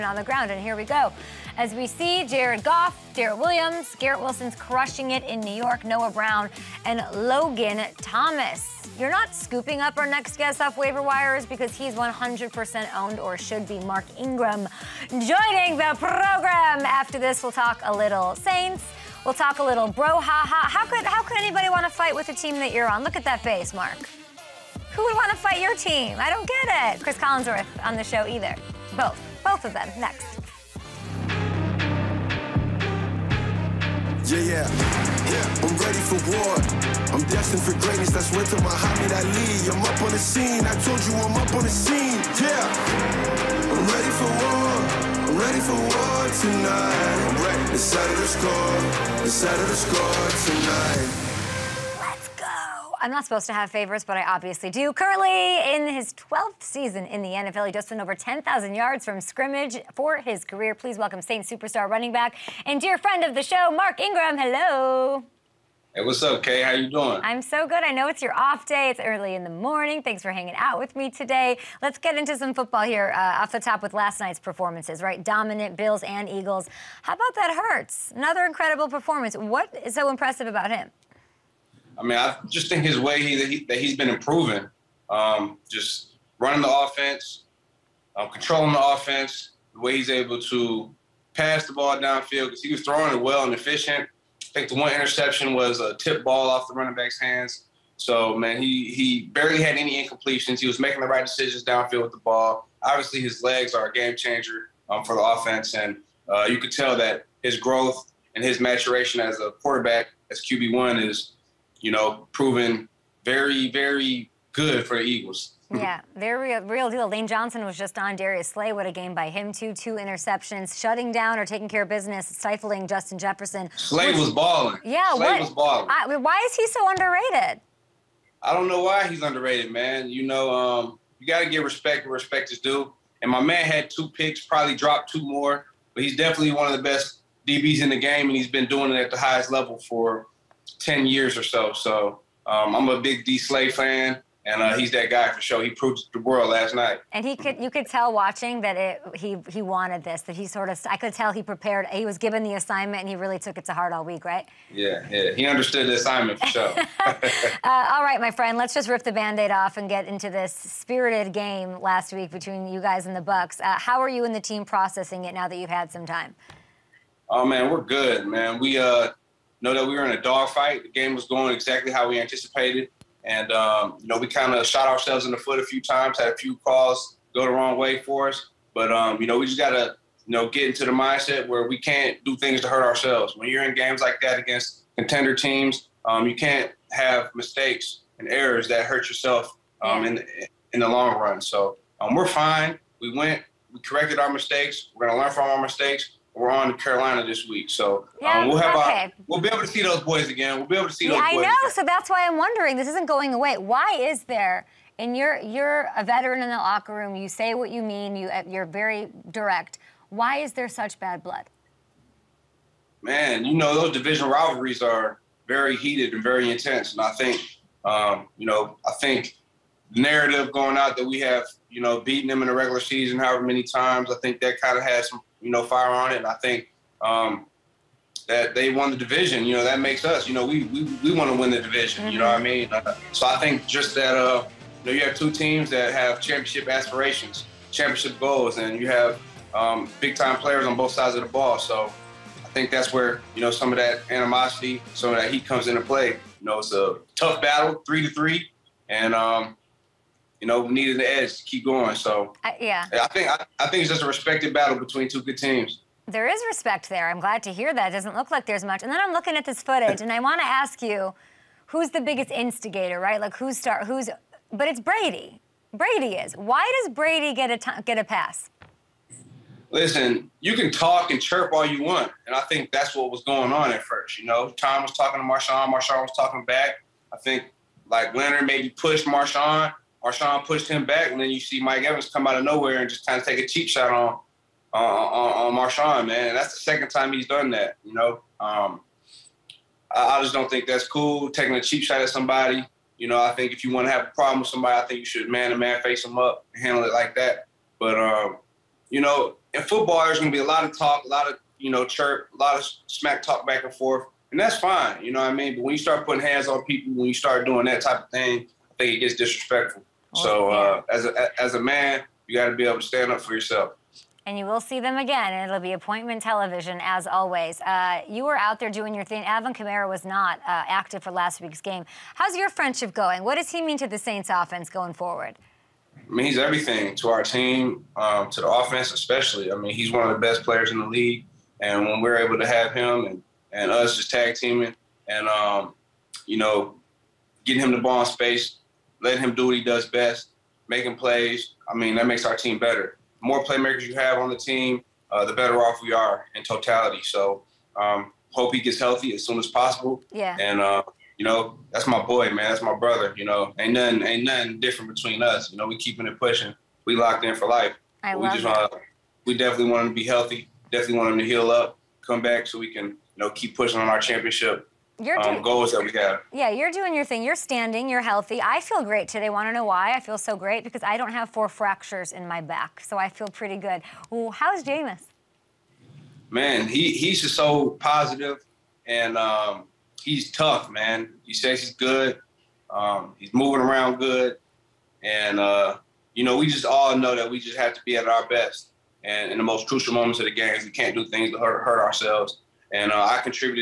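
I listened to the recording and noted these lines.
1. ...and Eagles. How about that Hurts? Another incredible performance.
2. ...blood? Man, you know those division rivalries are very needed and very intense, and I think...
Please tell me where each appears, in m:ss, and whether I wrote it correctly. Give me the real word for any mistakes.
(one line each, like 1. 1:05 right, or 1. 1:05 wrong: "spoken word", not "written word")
1. 1:16 right
2. 3:31 wrong: "heated", not "needed".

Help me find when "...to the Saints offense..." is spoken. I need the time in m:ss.
5:23.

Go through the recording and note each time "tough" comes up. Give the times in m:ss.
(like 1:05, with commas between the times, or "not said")
4:07, 6:20.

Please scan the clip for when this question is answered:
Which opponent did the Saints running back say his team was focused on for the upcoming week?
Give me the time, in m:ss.
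3:16.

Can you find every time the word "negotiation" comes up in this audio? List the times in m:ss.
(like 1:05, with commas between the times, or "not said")
not said.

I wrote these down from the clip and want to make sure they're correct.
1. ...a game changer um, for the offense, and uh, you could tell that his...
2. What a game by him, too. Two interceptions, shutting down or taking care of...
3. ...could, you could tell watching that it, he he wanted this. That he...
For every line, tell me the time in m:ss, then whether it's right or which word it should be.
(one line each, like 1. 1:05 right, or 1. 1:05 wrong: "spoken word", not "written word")
1. 1:43 right
2. 1:58 right
3. 2:27 right.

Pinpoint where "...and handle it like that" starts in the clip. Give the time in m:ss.
4:56.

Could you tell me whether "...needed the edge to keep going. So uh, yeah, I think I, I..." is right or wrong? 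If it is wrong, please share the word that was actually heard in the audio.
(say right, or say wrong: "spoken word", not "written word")
right.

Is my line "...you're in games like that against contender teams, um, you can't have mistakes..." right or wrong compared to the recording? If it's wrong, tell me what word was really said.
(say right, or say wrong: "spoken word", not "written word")
right.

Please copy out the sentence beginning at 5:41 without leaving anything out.
I mean, that makes our team better.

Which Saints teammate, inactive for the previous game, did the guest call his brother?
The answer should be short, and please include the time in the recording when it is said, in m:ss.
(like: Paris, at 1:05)
Alvin Kamara, at 5:19.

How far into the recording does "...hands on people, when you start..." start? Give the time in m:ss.
5:06.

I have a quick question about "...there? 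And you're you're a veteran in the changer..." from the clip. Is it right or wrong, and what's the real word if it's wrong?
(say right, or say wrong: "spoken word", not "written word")
wrong: "locker", not "changer".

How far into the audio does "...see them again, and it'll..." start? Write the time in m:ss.
5:14.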